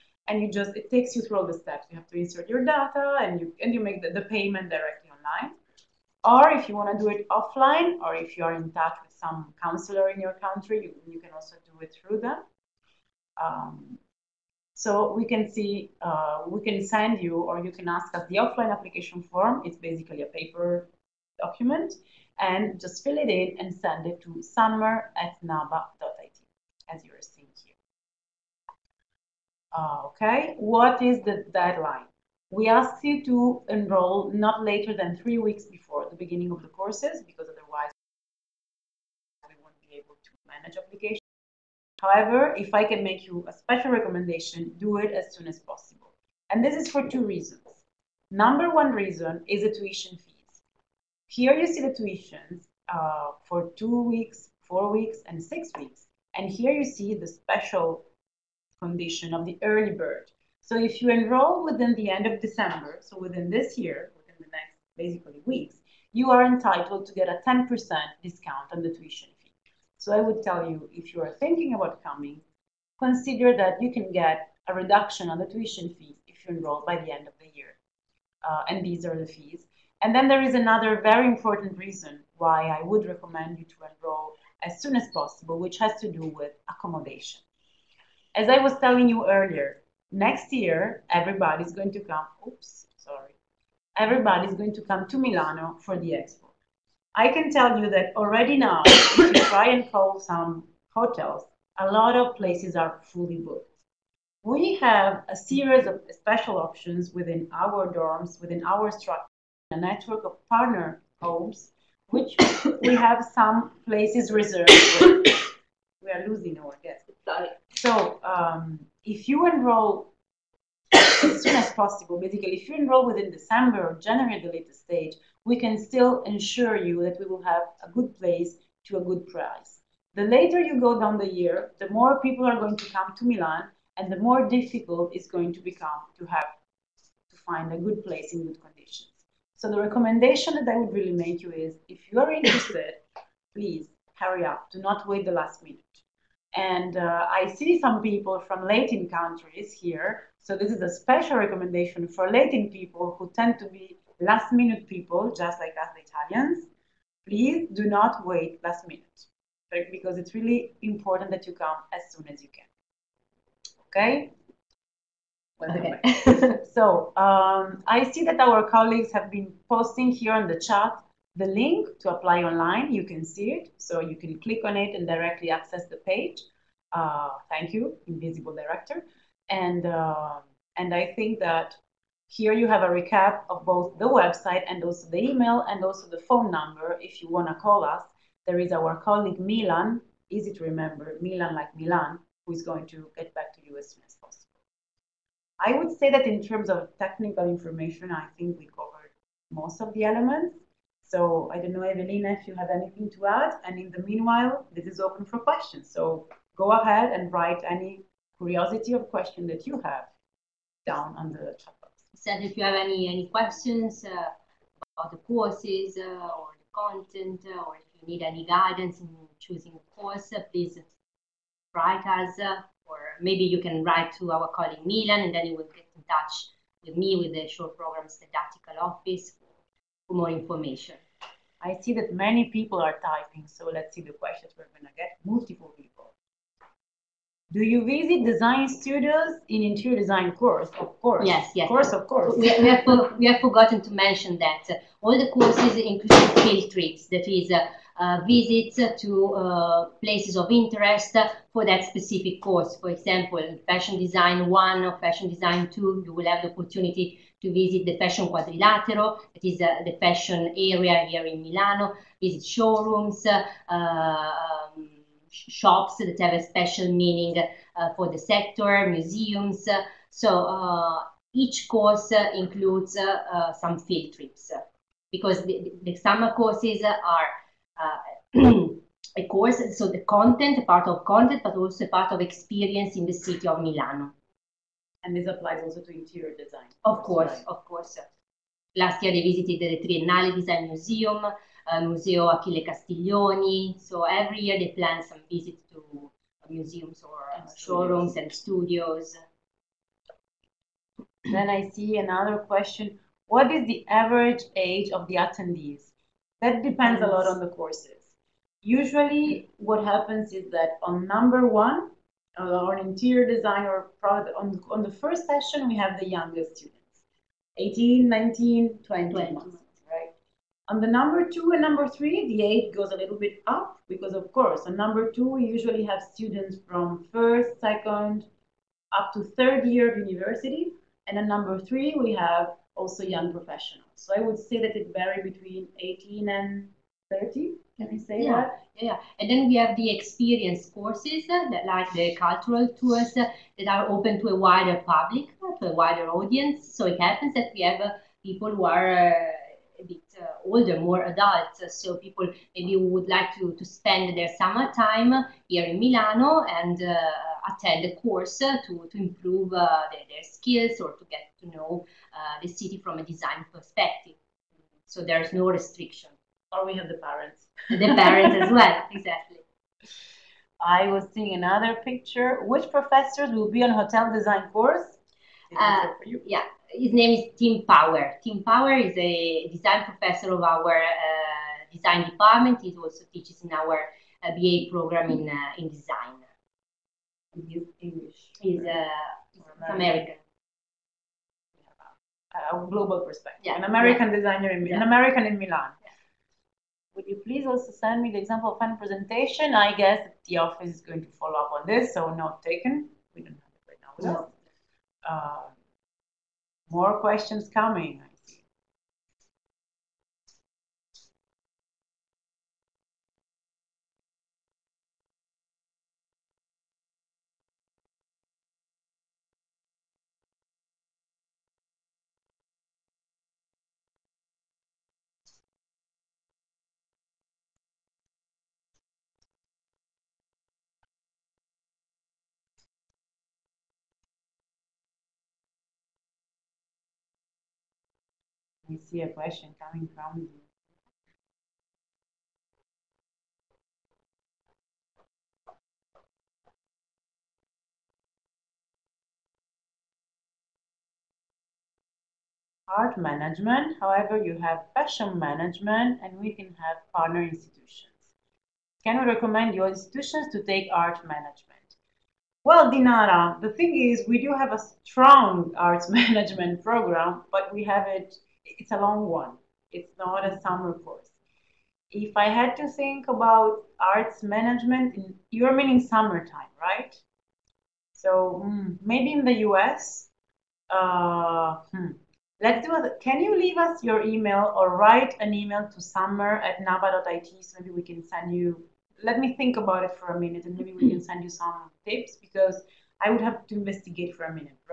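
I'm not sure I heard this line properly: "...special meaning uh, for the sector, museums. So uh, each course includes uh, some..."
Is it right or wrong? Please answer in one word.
right.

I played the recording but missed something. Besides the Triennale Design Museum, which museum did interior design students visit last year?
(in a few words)
Museo Achille Castiglioni.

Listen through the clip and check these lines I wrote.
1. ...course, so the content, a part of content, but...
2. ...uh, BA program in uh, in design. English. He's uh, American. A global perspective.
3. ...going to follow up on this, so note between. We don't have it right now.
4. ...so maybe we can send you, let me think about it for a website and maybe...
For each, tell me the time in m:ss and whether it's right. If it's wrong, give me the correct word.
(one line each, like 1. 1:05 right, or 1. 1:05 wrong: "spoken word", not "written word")
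1. 4:39 right
2. 6:24 right
3. 6:40 wrong: "taken", not "between"
4. 8:07 wrong: "minute", not "website".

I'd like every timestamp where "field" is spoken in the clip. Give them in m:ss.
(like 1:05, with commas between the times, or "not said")
4:06, 4:33.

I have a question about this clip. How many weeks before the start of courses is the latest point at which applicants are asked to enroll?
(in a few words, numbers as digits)
3 weeks.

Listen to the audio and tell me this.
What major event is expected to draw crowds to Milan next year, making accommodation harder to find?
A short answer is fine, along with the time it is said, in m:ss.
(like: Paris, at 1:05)
the expo, at 1:35.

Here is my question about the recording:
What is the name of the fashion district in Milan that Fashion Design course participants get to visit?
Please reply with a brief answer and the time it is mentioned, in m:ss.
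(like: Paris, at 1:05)
Fashion Quadrilatero, at 4:17.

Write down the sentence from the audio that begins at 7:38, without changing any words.
Can we recommend your institutions to take art management?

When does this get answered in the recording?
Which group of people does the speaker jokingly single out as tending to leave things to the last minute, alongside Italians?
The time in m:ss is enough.
2:32.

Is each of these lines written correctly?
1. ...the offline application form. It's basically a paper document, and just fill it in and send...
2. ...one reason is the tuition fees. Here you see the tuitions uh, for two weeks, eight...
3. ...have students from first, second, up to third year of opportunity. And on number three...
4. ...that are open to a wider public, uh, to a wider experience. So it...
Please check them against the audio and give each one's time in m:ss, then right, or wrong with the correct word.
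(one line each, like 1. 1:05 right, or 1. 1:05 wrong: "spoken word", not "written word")
1. 0:18 right
2. 0:48 wrong: "four", not "eight"
3. 5:25 wrong: "university", not "opportunity"
4. 5:43 wrong: "audience", not "experience".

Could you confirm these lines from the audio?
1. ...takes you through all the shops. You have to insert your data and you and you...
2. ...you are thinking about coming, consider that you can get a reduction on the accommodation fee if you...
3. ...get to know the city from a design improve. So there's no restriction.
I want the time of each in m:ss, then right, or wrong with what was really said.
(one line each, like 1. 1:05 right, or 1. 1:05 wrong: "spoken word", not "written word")
1. 0:00 wrong: "steps", not "shops"
2. 1:11 wrong: "tuition", not "accommodation"
3. 6:01 wrong: "perspective", not "improve".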